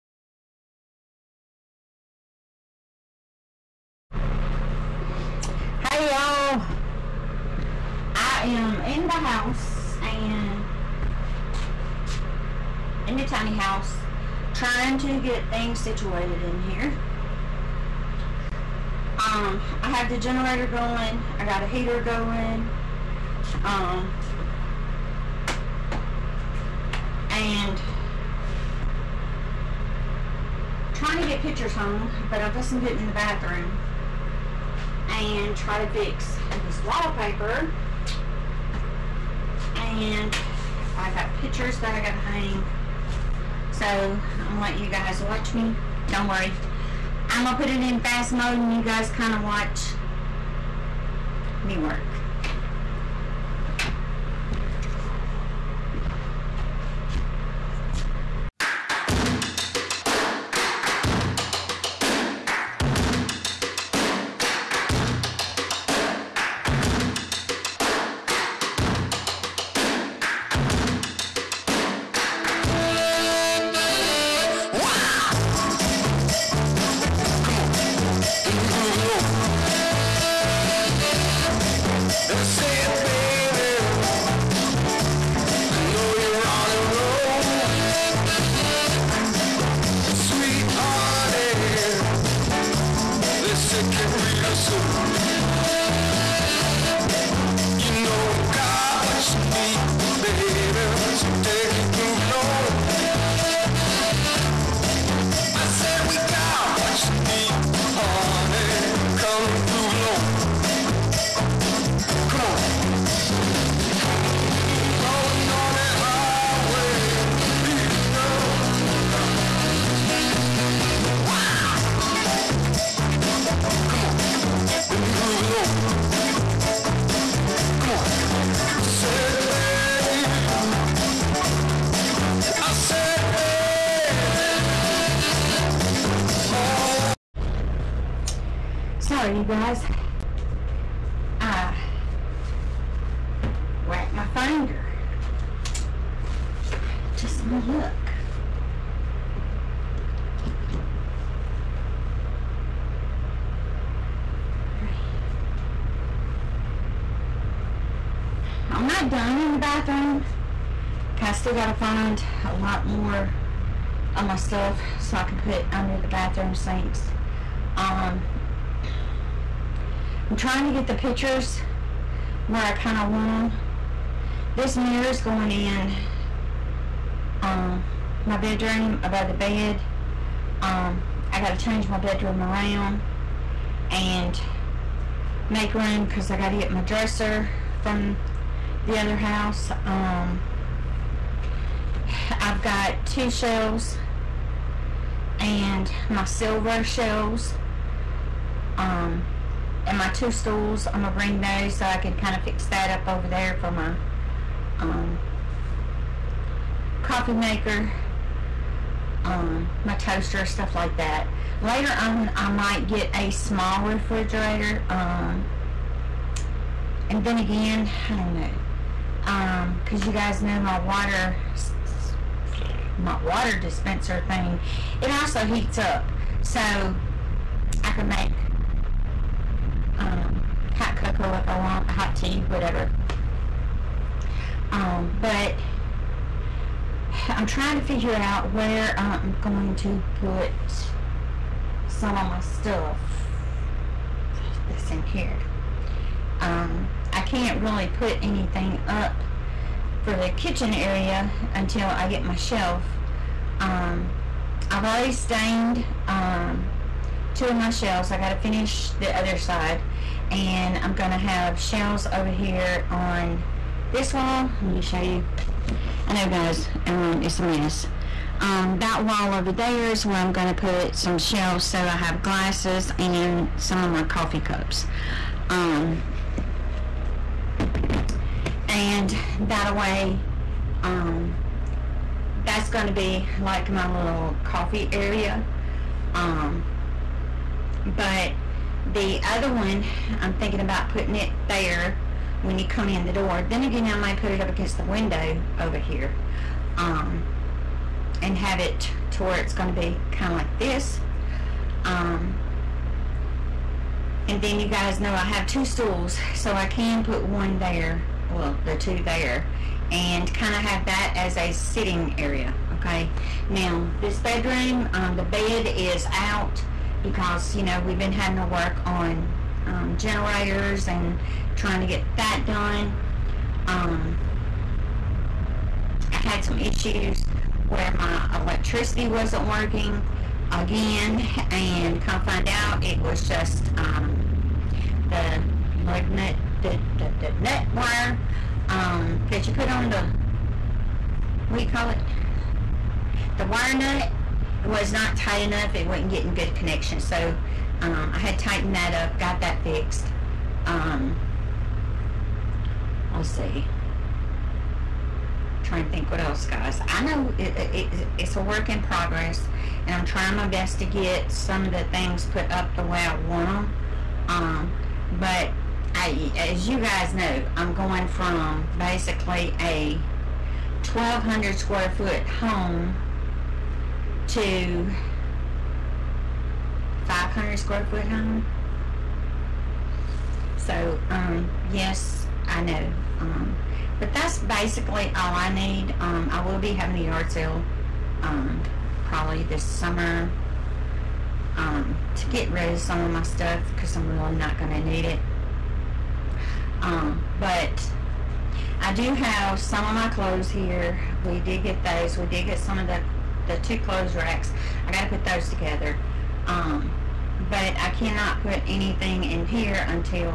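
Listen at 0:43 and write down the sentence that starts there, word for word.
So I'm gonna let you guys watch me.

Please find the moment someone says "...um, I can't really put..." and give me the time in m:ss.
4:06.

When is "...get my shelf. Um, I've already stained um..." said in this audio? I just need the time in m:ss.
4:12.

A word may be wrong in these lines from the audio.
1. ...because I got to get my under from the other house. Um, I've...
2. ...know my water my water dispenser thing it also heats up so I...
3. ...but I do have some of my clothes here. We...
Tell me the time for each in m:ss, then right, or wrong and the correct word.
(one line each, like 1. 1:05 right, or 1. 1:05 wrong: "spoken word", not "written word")
1. 3:06 wrong: "dresser", not "under"
2. 3:40 right
3. 6:37 right.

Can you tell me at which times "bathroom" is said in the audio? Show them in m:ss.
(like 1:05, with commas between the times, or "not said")
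0:33, 2:39, 2:46.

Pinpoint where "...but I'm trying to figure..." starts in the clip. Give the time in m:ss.
3:55.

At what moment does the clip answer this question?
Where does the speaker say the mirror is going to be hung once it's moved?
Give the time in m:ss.
2:59.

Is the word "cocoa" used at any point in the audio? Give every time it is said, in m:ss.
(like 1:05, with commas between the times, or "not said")
3:50.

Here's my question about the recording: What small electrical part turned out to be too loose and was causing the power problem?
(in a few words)
Wire nut.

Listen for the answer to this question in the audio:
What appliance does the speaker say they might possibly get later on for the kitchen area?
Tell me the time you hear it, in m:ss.
3:33.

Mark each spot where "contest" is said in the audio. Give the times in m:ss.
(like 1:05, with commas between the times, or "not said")
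not said.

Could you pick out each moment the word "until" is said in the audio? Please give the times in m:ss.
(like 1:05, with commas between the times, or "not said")
4:11.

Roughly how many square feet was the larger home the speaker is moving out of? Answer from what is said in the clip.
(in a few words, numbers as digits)
1,200.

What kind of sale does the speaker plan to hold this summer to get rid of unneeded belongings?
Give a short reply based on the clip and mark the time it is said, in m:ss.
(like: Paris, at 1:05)
Yard sale, at 6:27.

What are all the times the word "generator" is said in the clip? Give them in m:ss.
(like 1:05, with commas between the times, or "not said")
0:20, 5:19.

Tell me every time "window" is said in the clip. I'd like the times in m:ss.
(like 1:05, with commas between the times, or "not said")
4:54.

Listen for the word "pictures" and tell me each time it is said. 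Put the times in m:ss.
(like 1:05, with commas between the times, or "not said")
0:31, 0:41, 2:50.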